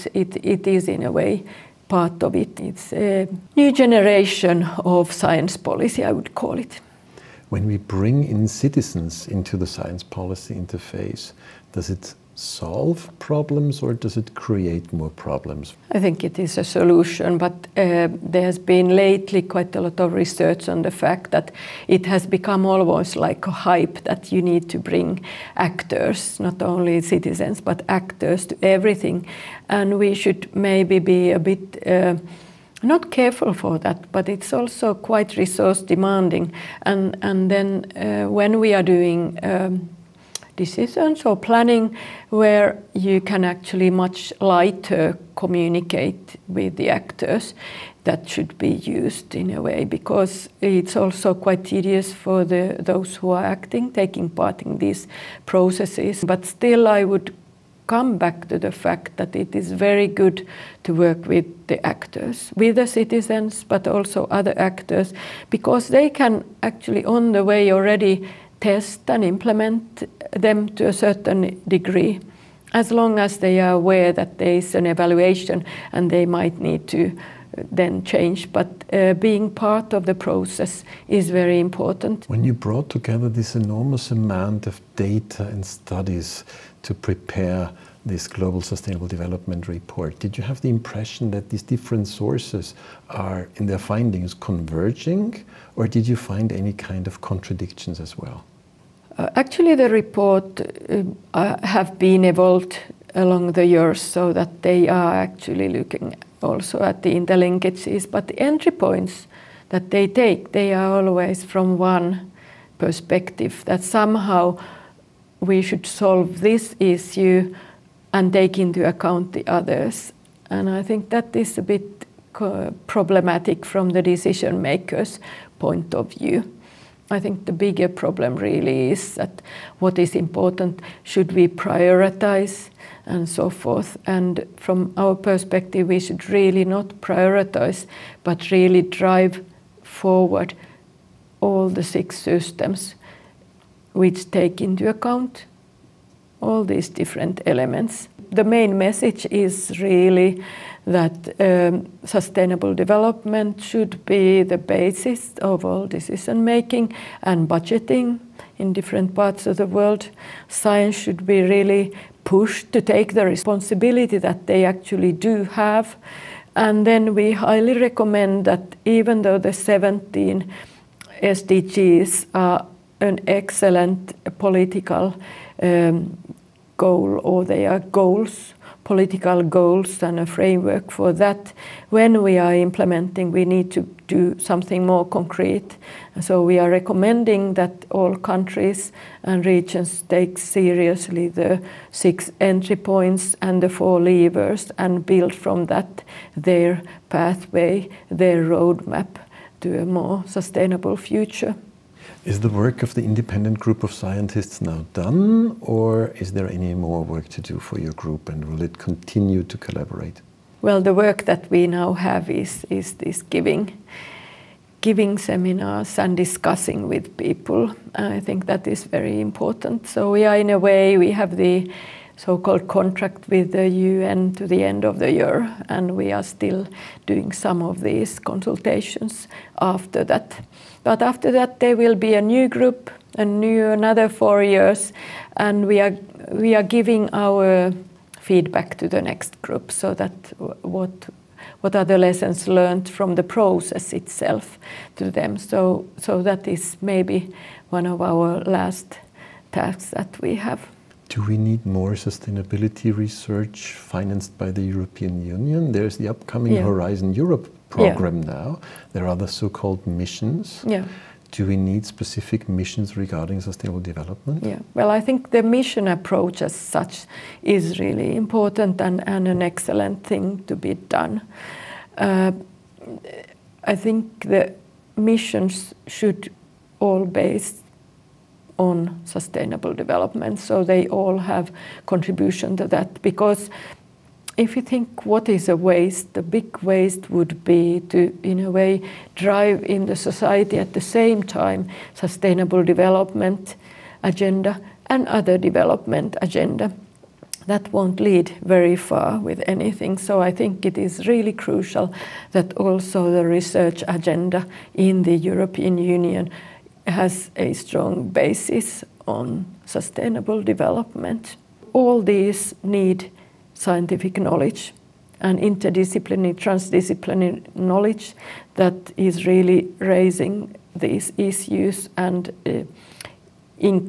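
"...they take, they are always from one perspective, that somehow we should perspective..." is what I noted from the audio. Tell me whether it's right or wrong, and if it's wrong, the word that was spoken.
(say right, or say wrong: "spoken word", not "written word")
wrong: "solve", not "perspective".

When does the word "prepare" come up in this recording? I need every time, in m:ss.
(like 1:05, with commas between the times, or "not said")
1:26.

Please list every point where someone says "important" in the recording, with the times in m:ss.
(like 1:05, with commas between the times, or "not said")
1:21, 2:10, 3:39, 4:28.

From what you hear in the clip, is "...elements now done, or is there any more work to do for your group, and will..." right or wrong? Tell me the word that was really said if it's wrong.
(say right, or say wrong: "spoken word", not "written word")
wrong: "scientists", not "elements".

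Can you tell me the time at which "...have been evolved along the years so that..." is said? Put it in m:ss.
1:41.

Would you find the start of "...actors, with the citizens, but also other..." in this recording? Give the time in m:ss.
1:01.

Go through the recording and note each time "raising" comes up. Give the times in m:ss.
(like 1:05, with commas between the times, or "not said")
5:19.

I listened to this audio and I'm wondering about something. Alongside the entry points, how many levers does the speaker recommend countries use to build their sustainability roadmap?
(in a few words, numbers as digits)
4.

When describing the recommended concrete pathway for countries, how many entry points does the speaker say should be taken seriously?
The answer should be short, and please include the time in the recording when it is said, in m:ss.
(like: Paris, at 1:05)
6, at 3:11.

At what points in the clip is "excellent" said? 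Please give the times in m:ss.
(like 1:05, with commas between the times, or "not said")
2:53, 4:29.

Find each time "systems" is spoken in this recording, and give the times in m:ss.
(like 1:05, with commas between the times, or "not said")
2:22.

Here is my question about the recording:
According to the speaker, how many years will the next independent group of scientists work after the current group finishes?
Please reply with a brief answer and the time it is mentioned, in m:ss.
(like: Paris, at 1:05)
4, at 3:54.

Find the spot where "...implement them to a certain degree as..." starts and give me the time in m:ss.
1:09.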